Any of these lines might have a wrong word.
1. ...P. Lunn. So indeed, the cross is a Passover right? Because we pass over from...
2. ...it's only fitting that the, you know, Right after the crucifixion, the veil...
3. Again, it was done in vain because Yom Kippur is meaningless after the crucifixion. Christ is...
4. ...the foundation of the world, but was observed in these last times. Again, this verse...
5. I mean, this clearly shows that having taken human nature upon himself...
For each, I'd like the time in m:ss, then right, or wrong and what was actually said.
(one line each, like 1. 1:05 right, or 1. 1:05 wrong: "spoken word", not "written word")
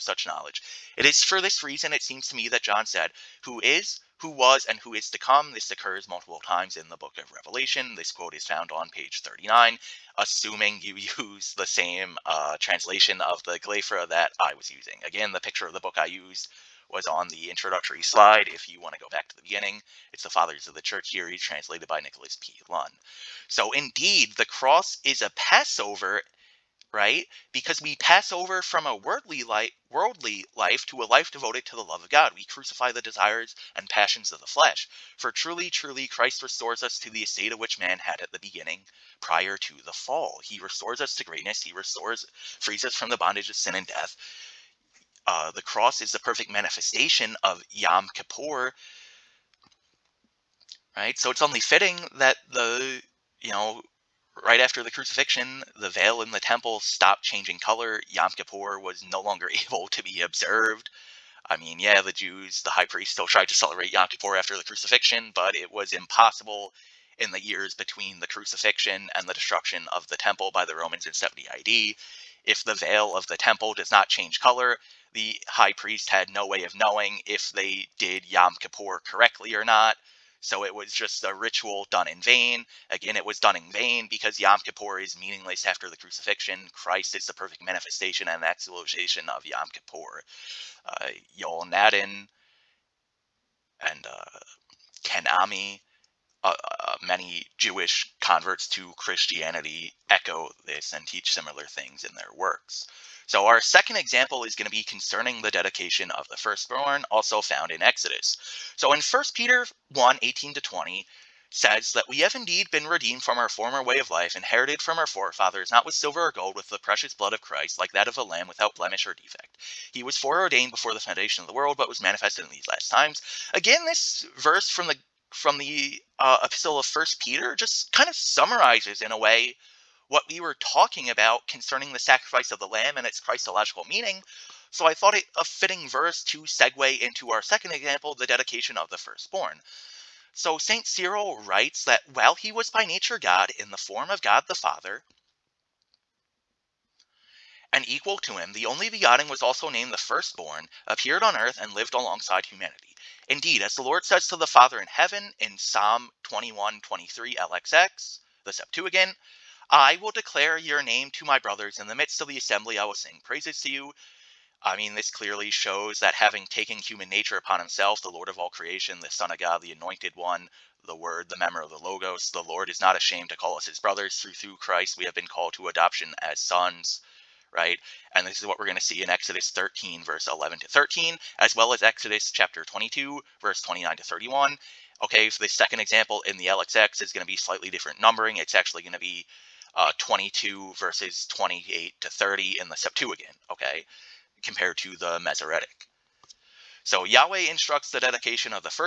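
1. 0:22 right
2. 0:51 right
3. 1:22 right
4. 2:00 wrong: "manifested", not "observed"
5. 2:44 right.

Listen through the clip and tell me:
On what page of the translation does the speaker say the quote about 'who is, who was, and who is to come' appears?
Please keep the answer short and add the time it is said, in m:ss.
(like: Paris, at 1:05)
39, at 0:08.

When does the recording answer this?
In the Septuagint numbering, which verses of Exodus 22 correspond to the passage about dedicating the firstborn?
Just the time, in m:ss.
3:10.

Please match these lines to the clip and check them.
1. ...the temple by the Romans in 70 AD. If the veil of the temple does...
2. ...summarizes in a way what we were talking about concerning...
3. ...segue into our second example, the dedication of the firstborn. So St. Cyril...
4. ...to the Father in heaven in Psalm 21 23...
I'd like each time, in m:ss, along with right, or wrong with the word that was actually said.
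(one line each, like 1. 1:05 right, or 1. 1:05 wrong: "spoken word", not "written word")
1. 1:10 right
2. 2:08 right
3. 2:16 right
4. 2:34 right.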